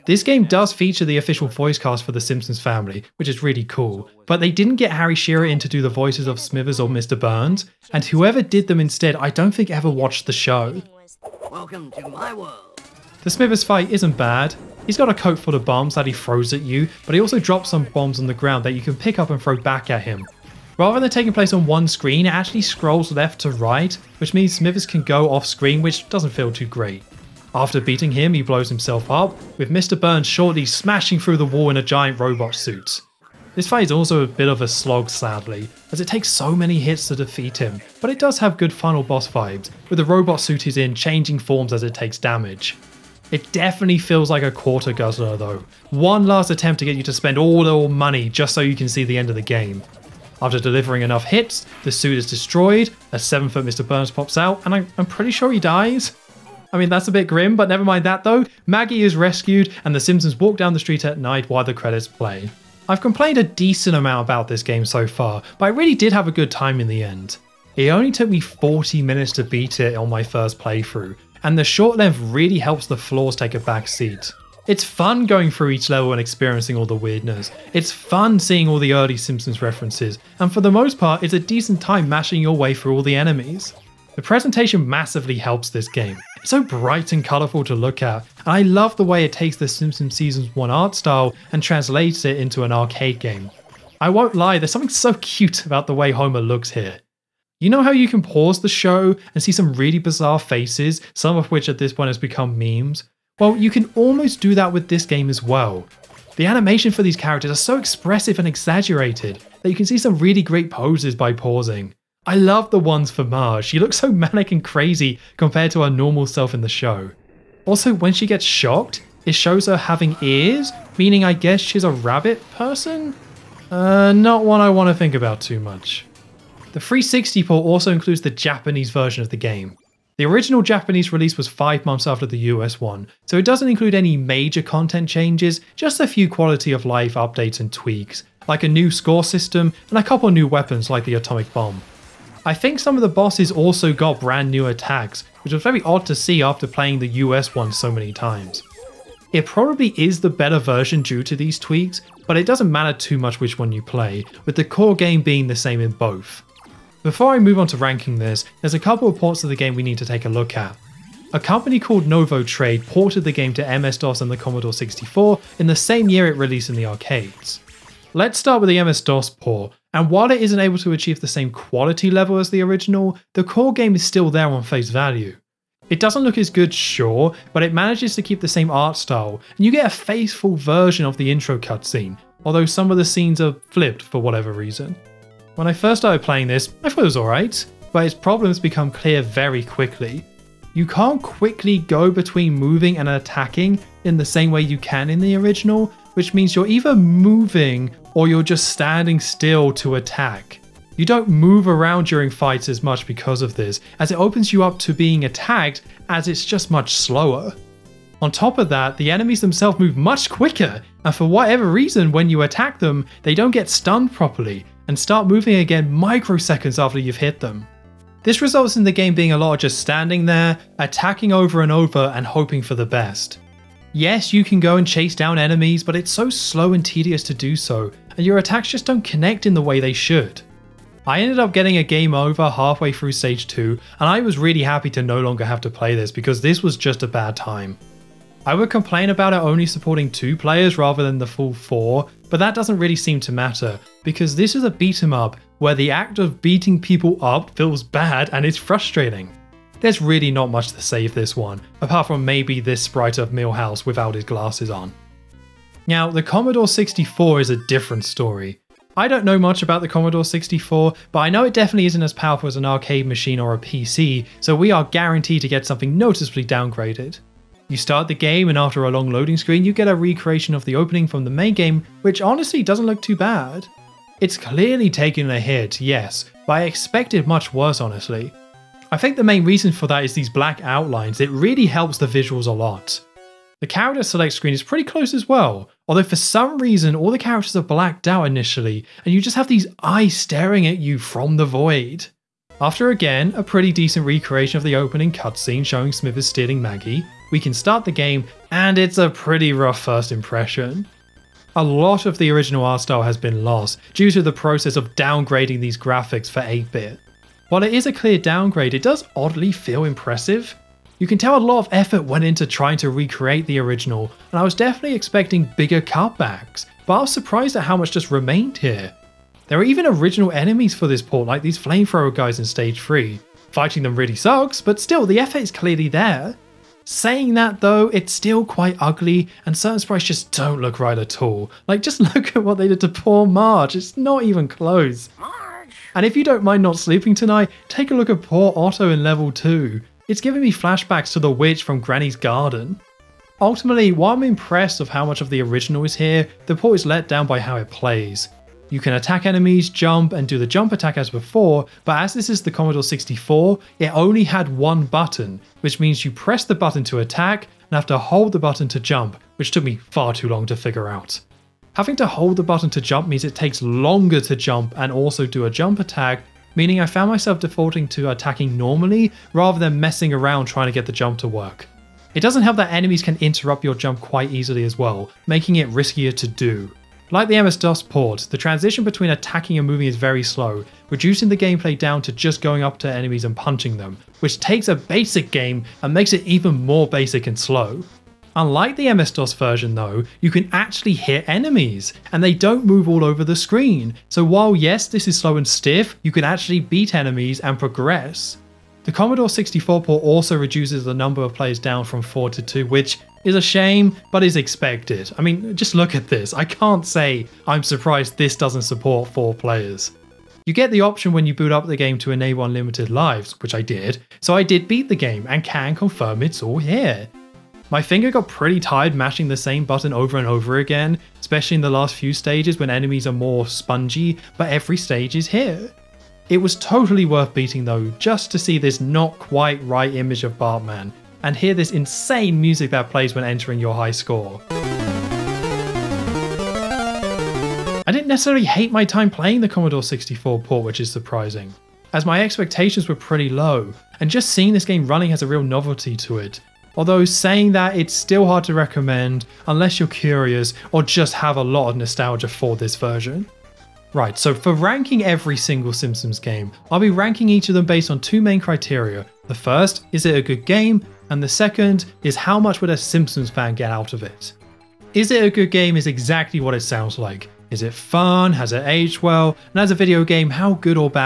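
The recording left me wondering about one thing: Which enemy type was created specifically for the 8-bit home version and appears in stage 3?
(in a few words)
flamethrower guys.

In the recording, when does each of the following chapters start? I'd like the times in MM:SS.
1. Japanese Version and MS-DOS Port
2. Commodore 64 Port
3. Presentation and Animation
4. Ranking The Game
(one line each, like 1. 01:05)
1. 02:06
2. 04:14
3. 01:02
4. 07:32.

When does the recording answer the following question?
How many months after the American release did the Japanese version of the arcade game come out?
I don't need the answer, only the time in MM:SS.
02:11.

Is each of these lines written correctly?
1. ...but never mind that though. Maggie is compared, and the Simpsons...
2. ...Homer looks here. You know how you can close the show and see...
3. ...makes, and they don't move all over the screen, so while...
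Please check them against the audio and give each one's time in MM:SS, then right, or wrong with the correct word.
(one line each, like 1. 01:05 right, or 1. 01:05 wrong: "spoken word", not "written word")
1. 00:57 wrong: "rescued", not "compared"
2. 01:36 wrong: "pause", not "close"
3. 06:31 wrong: "enemies", not "makes".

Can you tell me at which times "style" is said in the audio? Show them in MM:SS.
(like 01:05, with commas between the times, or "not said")
01:30, 02:58, 05:02.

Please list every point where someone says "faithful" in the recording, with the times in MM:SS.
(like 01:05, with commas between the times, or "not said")
02:59.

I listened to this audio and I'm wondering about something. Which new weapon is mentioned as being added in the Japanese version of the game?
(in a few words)
atomic bomb.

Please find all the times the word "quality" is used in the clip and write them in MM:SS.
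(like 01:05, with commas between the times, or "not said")
02:16, 02:51.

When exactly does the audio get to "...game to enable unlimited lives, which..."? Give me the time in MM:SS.
06:51.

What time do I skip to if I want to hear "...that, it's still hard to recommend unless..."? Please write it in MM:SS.
07:27.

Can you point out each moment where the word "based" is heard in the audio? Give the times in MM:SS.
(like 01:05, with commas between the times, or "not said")
07:37.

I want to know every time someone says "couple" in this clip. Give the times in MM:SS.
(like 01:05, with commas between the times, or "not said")
02:20, 02:38.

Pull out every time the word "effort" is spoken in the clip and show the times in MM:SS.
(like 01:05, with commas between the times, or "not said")
05:11, 05:25.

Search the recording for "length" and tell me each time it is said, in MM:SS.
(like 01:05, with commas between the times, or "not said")
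01:11.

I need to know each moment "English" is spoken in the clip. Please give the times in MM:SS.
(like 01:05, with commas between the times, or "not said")
not said.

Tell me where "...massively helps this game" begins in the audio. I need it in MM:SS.
01:24.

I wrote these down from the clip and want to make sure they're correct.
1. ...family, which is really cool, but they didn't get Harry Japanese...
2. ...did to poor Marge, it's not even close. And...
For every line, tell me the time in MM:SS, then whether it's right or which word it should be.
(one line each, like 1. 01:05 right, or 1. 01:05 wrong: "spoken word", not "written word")
1. 00:02 wrong: "Shearer", not "Japanese"
2. 05:32 right.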